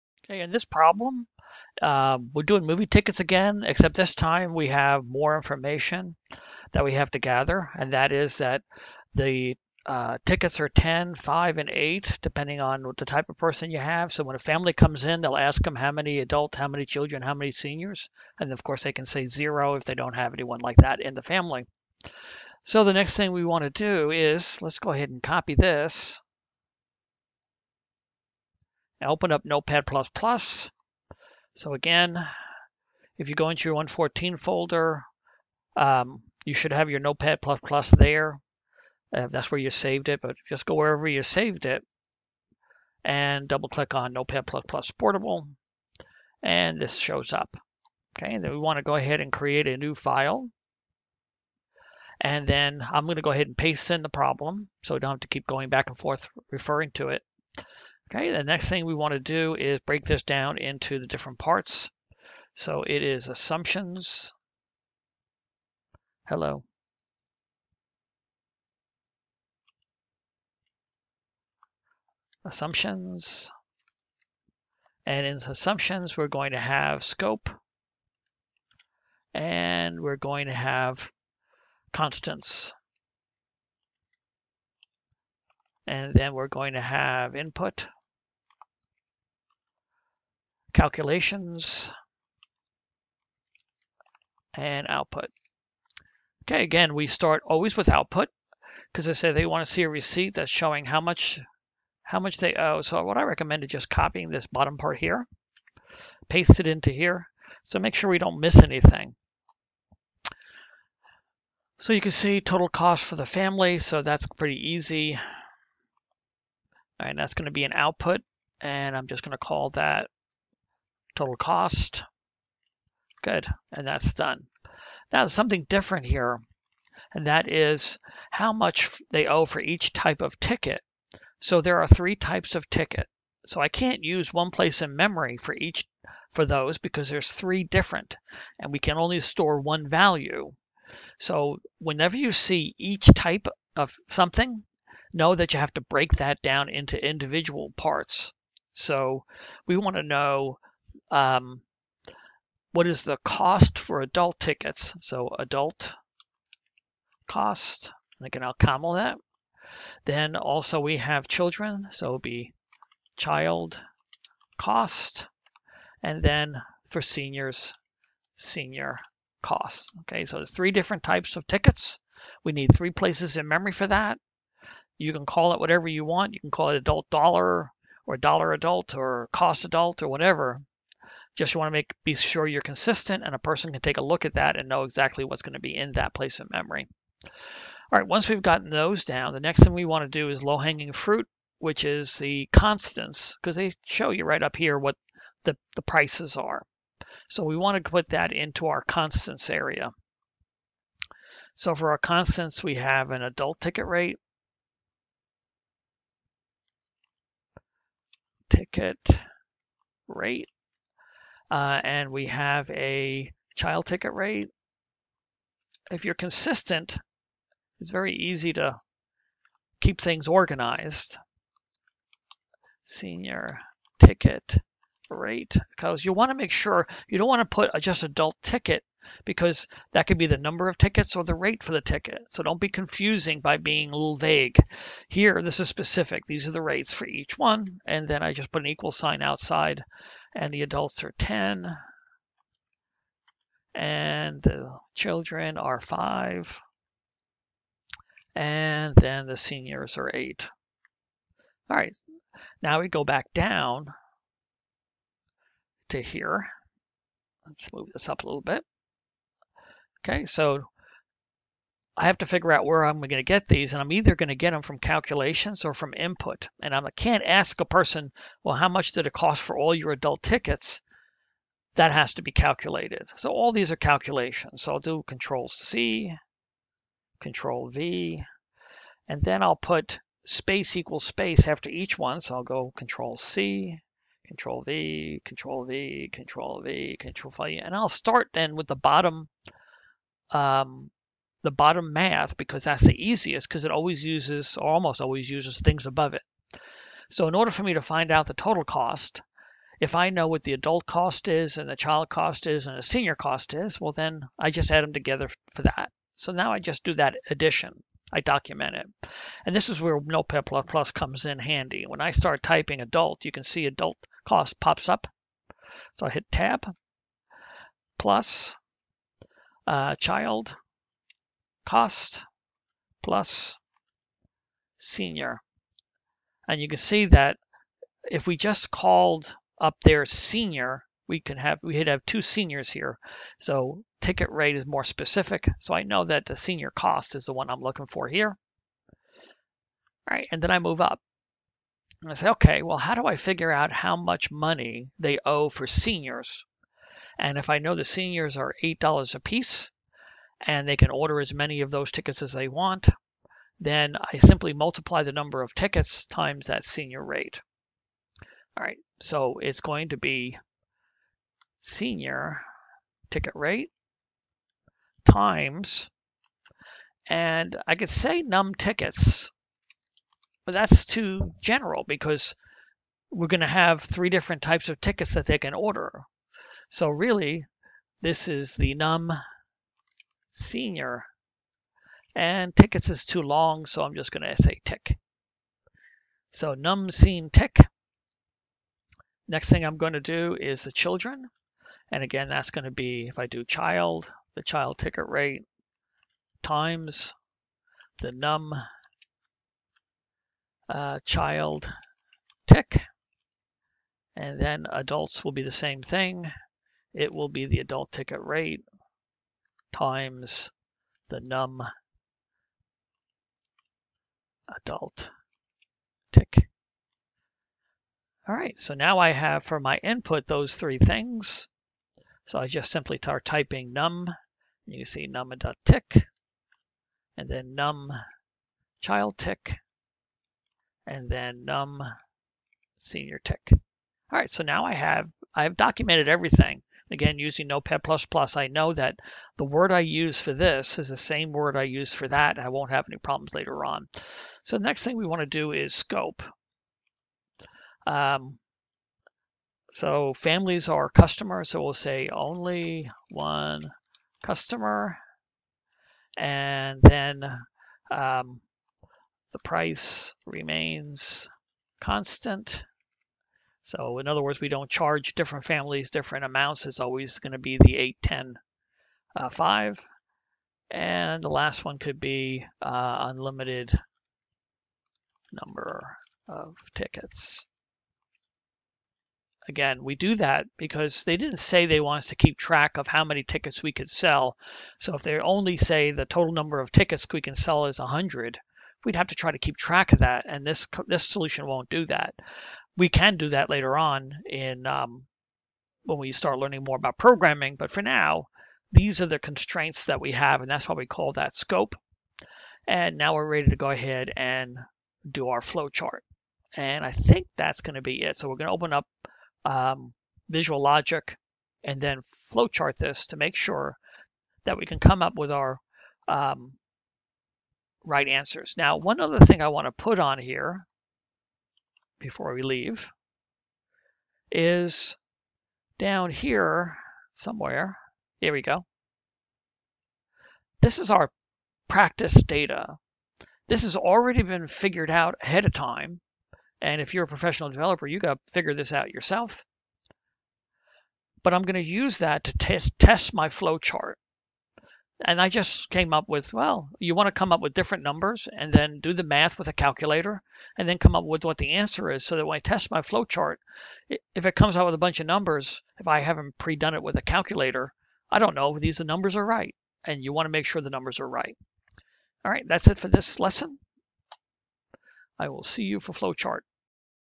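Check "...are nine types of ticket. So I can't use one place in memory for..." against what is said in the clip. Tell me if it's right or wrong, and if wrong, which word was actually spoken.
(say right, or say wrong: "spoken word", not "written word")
wrong: "three", not "nine".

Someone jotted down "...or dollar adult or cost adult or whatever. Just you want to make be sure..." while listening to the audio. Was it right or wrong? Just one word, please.
right.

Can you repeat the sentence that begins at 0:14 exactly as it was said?
So when a family comes in, they'll ask them how many adults, how many children, how many seniors.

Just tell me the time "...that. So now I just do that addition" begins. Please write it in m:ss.
5:05.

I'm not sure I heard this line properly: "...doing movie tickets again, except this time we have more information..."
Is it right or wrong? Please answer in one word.
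right.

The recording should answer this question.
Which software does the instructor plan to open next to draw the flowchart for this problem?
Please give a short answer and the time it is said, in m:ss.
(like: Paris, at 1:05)
Visual Logic, at 8:30.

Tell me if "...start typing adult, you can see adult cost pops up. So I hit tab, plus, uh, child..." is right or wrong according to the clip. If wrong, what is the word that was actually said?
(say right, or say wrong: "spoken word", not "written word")
right.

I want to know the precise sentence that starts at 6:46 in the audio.
It will be the adult ticket rate times the num adult tick.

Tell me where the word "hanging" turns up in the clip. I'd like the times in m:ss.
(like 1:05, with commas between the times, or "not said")
3:10.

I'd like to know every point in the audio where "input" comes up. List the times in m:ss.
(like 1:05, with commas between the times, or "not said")
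1:27, 4:25, 6:59.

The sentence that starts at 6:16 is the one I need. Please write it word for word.
So really, this is the num senior.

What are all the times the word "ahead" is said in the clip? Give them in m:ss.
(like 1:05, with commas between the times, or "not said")
0:24, 0:48, 0:53, 8:23, 8:55.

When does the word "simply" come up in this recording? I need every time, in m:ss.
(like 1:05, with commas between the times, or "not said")
5:54, 7:02.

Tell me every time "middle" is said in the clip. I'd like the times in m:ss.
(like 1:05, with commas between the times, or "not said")
not said.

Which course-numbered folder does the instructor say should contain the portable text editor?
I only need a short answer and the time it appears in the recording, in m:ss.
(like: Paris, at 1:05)
114, at 0:33.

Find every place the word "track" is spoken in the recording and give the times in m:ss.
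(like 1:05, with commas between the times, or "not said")
8:02, 8:09.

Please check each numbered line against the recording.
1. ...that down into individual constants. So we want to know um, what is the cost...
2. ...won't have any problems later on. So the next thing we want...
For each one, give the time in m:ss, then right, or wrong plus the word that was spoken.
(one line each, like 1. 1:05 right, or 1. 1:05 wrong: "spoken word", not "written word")
1. 2:26 wrong: "parts", not "constants"
2. 7:22 right.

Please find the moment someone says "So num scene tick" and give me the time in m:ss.
6:26.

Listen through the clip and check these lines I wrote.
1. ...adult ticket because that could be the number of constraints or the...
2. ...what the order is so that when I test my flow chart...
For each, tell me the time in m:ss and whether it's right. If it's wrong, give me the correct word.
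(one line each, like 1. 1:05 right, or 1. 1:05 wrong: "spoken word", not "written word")
1. 3:48 wrong: "tickets", not "constraints"
2. 9:11 wrong: "answer", not "order".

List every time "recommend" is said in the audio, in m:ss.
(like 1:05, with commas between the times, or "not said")
1:43.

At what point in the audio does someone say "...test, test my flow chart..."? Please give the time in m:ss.
9:02.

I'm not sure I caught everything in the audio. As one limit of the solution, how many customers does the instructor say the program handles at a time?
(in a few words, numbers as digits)
1.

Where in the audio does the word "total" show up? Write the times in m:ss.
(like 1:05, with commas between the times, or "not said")
1:52, 2:01, 4:58, 8:06.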